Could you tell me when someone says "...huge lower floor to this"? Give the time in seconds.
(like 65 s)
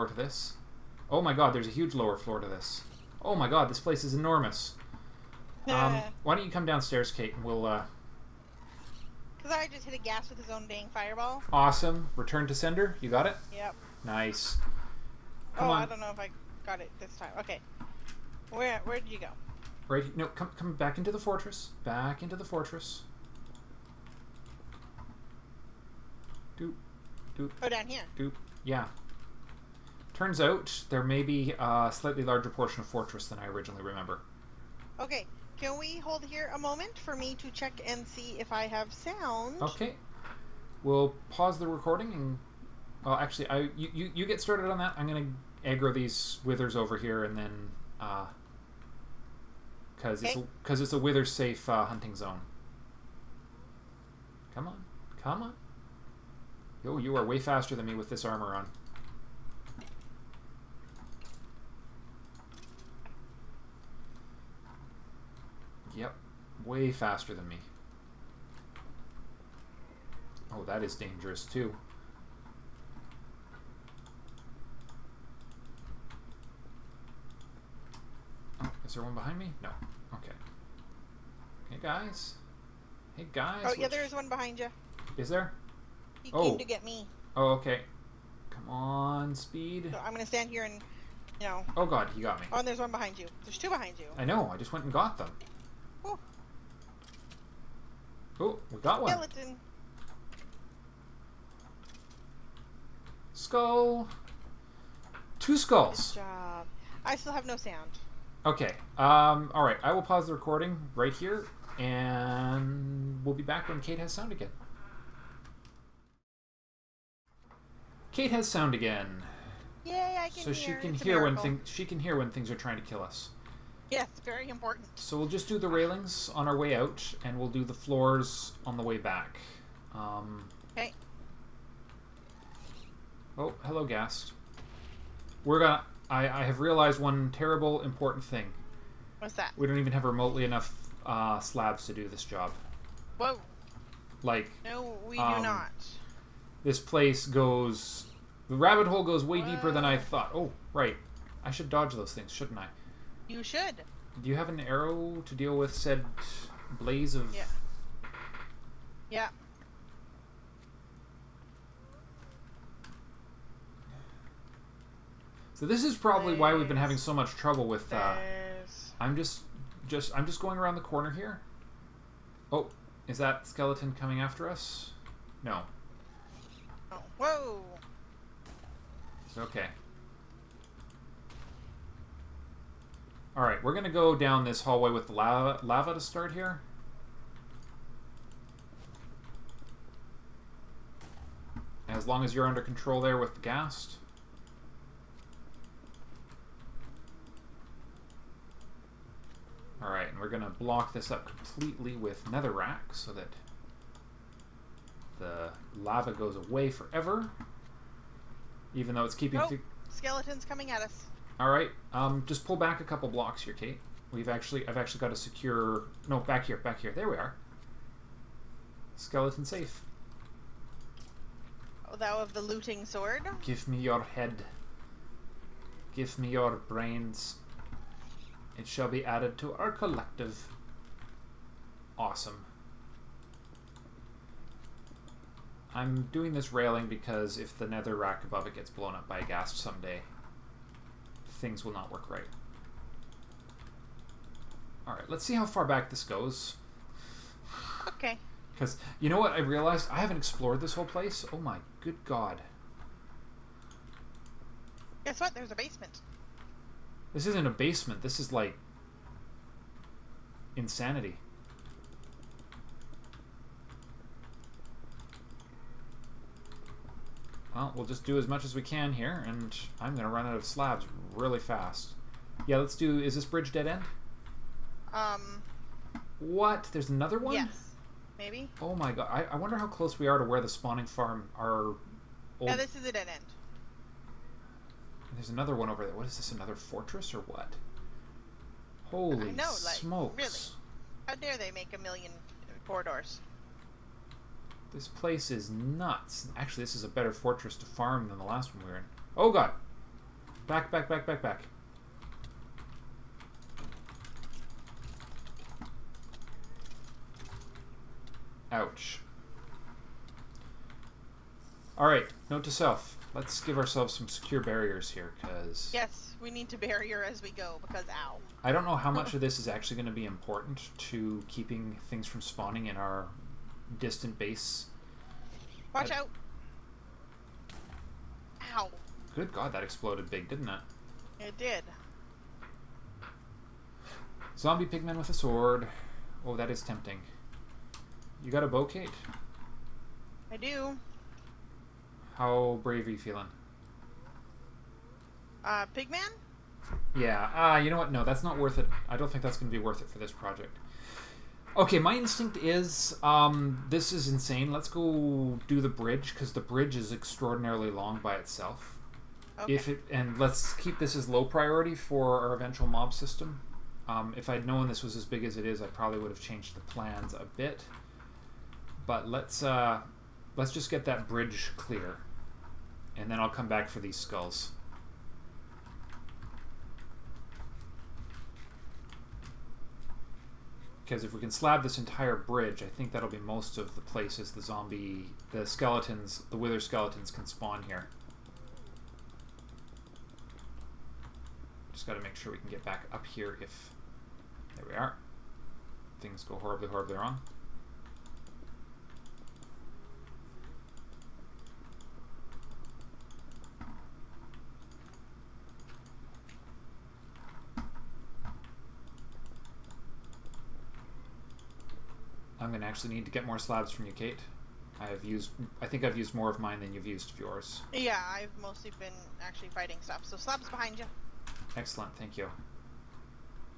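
1 s.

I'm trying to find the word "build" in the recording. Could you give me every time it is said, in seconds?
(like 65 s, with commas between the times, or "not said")
not said.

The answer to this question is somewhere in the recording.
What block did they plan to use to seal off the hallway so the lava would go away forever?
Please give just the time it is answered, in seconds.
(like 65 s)
202 s.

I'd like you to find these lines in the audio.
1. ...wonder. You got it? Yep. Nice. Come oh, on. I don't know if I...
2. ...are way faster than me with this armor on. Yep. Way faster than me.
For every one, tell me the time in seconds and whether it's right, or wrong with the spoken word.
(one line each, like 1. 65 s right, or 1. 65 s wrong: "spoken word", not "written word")
1. 12 s wrong: "sender", not "wonder"
2. 57 s right.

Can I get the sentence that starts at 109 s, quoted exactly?
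I will pause the recording right here, and we'll be back when Kate has sound again.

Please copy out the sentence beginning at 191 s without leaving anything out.
As long as you're under control there with the ghast.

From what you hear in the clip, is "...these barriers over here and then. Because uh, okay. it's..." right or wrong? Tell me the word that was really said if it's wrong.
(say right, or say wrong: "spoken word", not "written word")
wrong: "withers", not "barriers".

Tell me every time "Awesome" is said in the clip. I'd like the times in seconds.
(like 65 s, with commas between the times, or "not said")
11 s, 231 s.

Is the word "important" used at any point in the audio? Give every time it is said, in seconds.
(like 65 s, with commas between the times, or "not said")
124 s, 137 s, 320 s.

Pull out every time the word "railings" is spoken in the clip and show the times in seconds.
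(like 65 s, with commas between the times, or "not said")
125 s, 236 s.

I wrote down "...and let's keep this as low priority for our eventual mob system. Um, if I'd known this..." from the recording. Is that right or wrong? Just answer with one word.
right.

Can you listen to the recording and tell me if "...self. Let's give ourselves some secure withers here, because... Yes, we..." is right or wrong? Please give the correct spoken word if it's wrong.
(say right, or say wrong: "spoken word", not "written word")
wrong: "barriers", not "withers".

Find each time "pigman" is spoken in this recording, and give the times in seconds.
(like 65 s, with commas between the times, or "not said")
334 s, 345 s.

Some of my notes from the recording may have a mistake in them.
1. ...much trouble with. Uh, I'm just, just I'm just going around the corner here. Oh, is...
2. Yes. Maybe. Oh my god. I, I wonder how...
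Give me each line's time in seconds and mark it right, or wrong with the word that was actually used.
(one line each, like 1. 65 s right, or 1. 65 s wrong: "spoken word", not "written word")
1. 167 s right
2. 277 s right.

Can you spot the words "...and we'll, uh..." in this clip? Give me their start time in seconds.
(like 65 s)
7 s.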